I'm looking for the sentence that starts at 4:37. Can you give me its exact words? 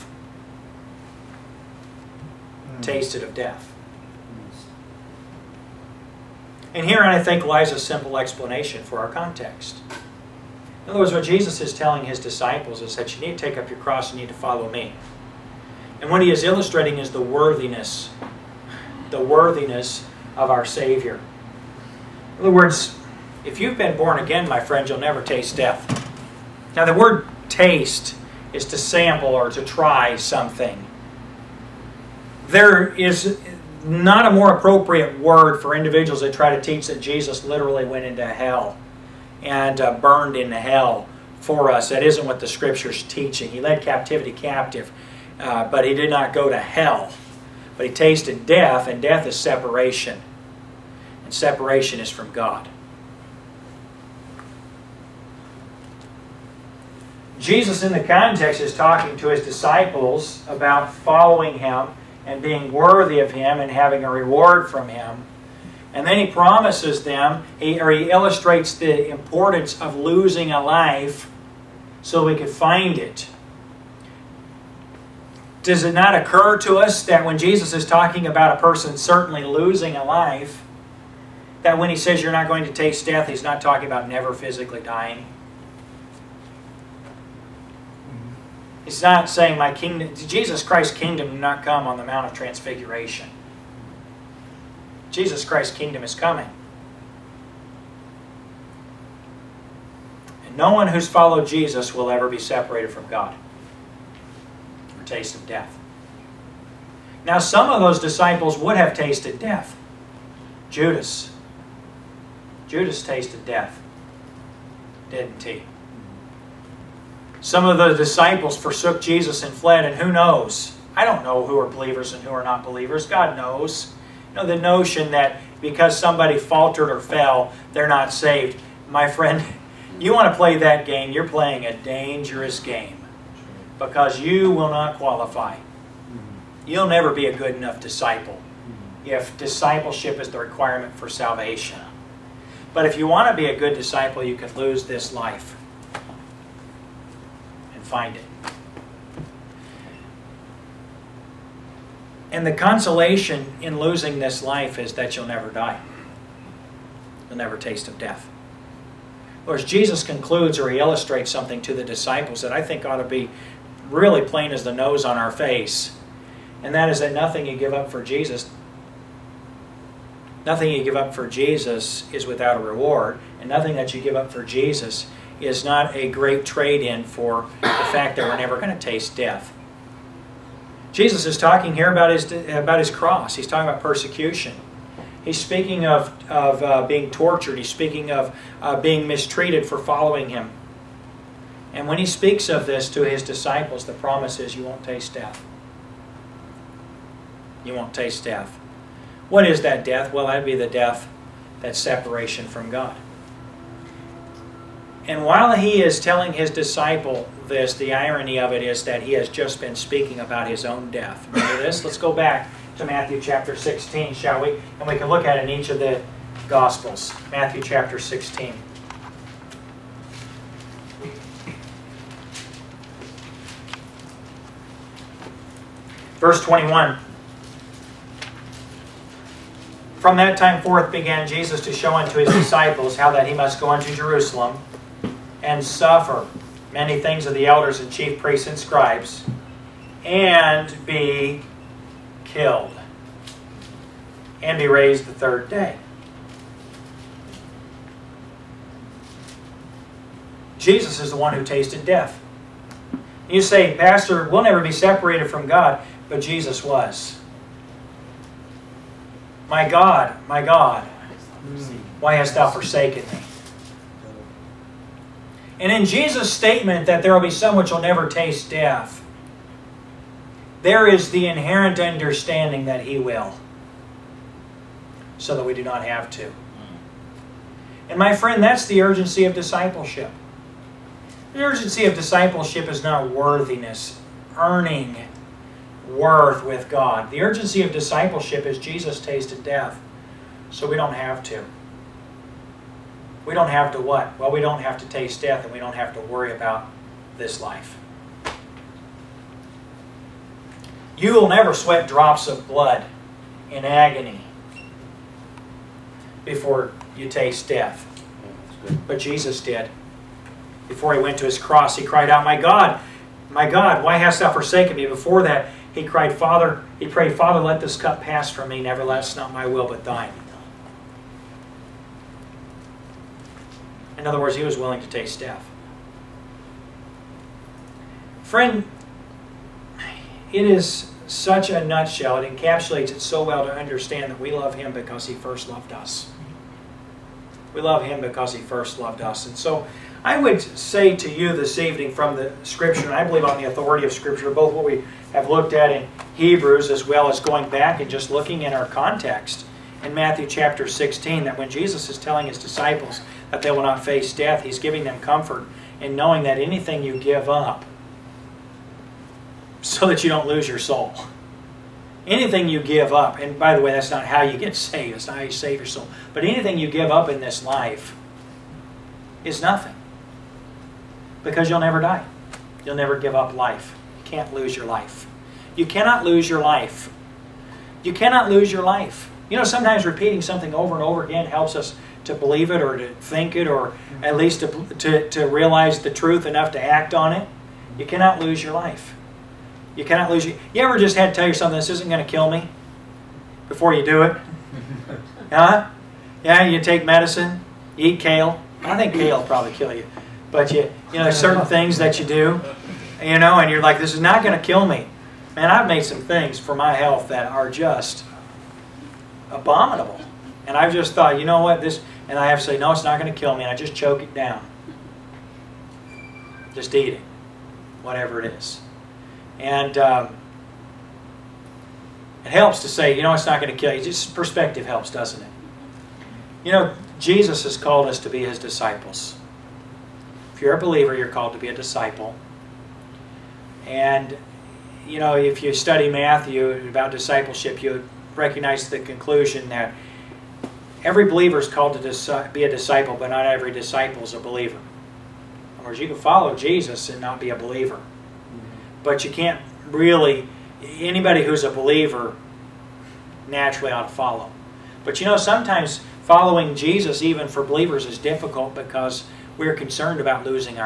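And my friend, that's the urgency of discipleship.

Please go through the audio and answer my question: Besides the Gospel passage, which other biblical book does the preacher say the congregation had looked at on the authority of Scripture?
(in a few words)
Hebrews.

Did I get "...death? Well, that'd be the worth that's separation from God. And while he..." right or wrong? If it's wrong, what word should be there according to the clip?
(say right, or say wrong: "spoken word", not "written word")
wrong: "death", not "worth".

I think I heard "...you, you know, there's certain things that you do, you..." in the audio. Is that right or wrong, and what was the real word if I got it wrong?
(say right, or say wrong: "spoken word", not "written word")
right.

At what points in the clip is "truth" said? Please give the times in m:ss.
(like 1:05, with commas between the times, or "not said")
6:25.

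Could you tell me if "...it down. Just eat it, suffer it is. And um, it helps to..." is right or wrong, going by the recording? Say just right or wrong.
wrong.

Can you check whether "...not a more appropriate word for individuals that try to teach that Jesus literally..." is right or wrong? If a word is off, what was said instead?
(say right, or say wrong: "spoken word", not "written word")
right.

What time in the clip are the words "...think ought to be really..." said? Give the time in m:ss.
2:42.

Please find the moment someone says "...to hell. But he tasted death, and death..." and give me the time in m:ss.
0:46.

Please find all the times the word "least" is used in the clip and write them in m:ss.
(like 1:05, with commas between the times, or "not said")
6:24.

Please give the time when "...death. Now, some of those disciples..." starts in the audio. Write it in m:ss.
1:45.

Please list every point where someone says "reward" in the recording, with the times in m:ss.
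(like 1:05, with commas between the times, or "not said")
1:04, 2:52.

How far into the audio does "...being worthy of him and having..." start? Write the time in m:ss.
1:02.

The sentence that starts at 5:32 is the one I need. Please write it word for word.
It encapsulates it so well to understand that we love him because he first loved us.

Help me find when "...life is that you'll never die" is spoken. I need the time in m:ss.
2:34.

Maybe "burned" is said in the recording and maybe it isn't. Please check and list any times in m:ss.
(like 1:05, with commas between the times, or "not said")
0:39.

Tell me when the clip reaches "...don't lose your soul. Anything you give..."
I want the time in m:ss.
6:00.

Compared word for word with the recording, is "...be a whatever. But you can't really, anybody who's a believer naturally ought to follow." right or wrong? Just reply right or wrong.
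wrong.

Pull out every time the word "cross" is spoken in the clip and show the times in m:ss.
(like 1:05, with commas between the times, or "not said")
0:13, 3:02, 5:11.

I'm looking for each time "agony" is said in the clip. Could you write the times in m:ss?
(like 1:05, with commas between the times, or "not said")
5:03.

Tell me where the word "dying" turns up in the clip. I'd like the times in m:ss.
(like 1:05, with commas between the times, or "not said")
1:24.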